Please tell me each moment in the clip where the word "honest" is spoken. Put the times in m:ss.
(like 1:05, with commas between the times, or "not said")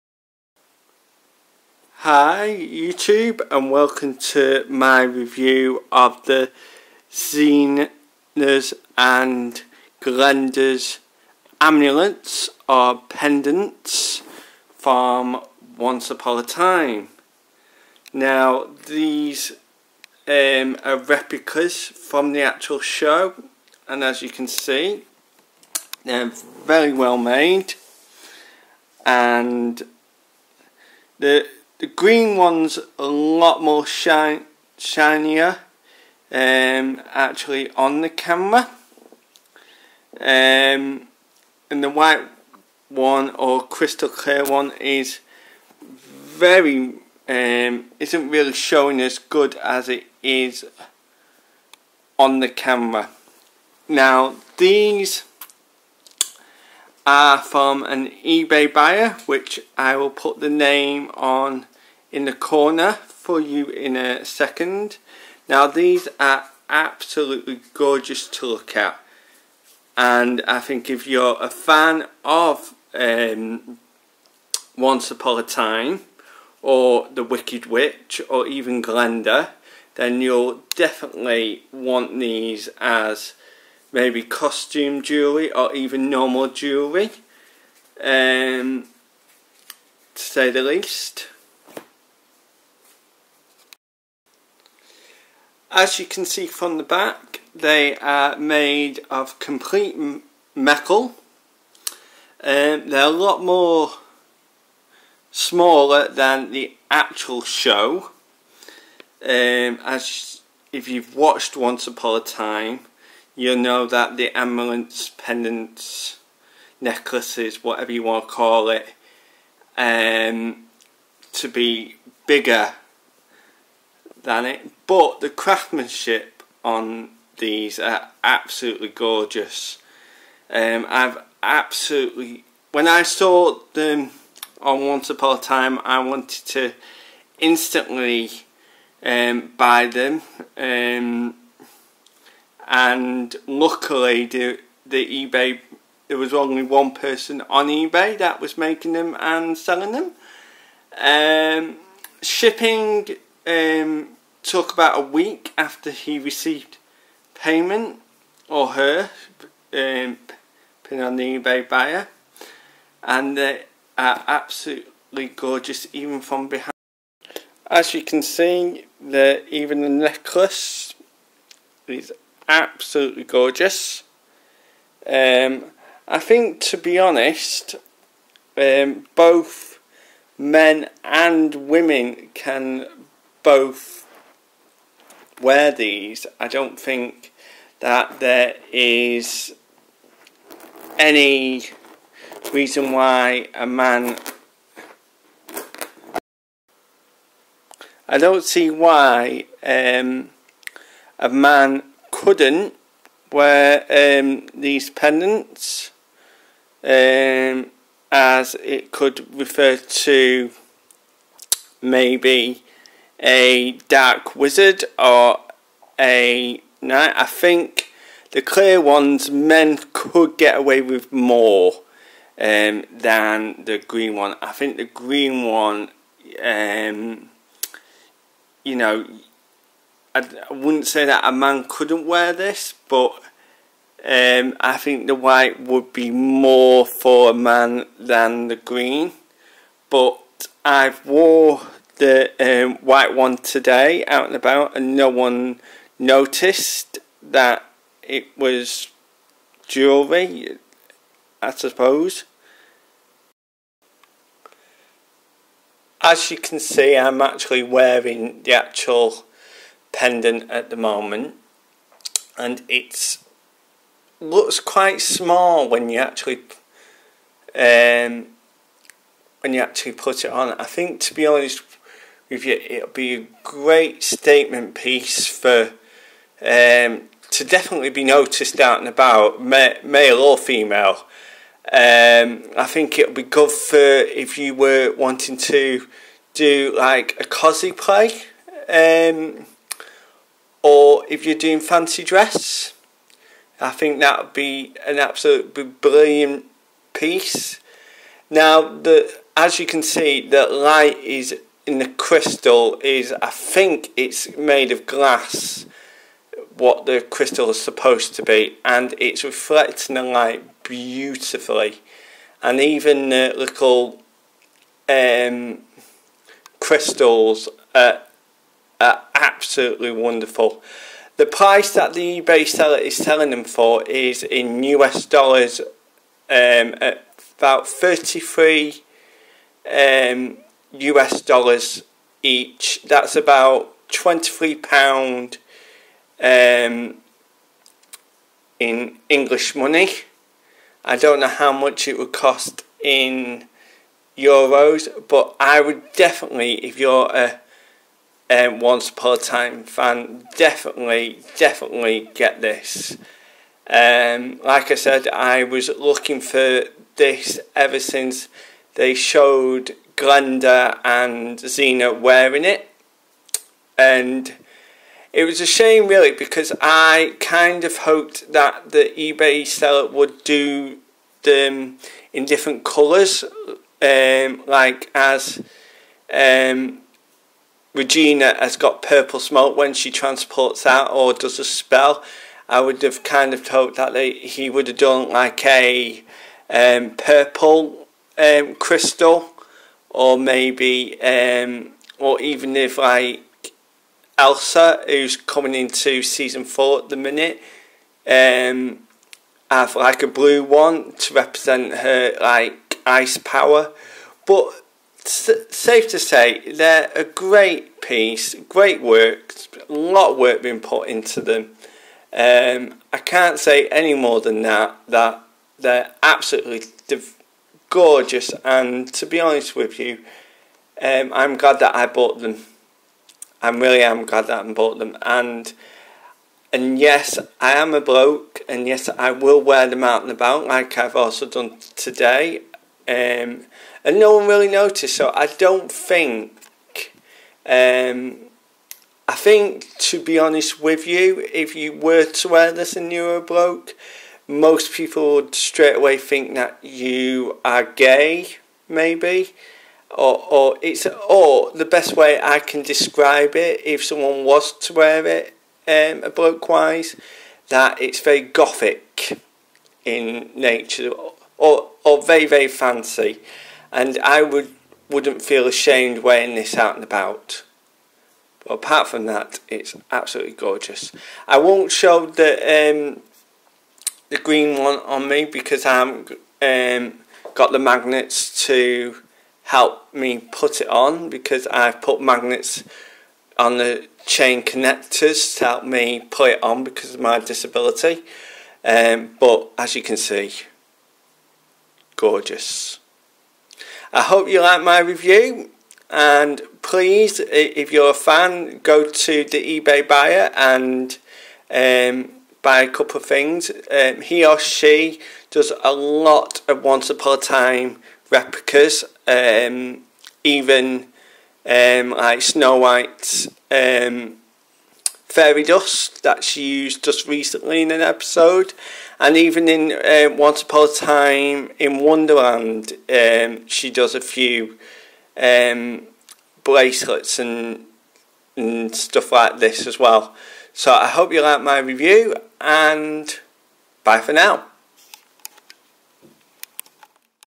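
2:56, 4:31, 6:59, 7:20.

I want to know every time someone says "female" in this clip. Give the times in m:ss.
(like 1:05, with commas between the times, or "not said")
4:40.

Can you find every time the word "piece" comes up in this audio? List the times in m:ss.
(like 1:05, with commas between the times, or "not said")
4:34, 4:56, 6:47.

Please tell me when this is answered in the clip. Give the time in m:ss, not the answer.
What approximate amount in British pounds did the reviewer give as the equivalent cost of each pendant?
5:33.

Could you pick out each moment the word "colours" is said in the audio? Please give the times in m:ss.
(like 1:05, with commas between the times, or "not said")
6:12.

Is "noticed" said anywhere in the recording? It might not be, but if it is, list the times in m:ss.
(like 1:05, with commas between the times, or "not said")
4:05, 4:38, 7:14.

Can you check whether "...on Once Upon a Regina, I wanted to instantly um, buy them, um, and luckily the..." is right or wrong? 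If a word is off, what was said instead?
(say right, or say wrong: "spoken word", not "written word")
wrong: "Time", not "Regina".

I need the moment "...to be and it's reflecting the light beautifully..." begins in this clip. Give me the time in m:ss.
5:08.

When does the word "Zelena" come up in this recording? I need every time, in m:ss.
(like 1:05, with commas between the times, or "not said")
0:07, 6:01.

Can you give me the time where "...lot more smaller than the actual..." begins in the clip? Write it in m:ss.
1:43.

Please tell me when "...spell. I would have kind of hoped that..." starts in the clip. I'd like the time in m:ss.
6:21.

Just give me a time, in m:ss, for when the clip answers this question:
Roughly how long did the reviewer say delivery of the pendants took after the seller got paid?
2:34.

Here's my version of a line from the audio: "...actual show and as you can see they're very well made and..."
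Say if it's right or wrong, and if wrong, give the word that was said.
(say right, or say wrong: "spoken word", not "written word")
right.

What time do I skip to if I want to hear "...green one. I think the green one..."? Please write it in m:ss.
3:43.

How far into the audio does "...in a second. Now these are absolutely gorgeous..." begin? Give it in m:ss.
1:03.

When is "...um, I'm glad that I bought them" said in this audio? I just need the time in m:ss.
7:00.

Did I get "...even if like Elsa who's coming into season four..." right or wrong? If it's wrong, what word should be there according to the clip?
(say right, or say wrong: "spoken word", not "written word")
right.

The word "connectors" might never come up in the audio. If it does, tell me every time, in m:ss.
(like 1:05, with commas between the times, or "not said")
8:04.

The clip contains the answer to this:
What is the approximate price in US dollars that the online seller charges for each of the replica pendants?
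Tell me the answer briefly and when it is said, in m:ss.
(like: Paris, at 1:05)
33, at 5:27.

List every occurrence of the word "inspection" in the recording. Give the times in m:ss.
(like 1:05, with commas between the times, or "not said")
not said.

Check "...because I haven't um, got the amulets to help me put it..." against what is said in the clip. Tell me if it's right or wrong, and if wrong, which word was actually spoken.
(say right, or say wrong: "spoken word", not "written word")
wrong: "magnets", not "amulets".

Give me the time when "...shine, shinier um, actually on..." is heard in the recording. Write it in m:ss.
0:33.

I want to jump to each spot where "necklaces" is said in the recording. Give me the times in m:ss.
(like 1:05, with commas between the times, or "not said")
1:56, 2:49.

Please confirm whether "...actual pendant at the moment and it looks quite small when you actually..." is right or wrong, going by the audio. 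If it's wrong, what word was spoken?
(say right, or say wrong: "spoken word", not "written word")
right.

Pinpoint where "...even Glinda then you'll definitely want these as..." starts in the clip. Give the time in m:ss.
1:18.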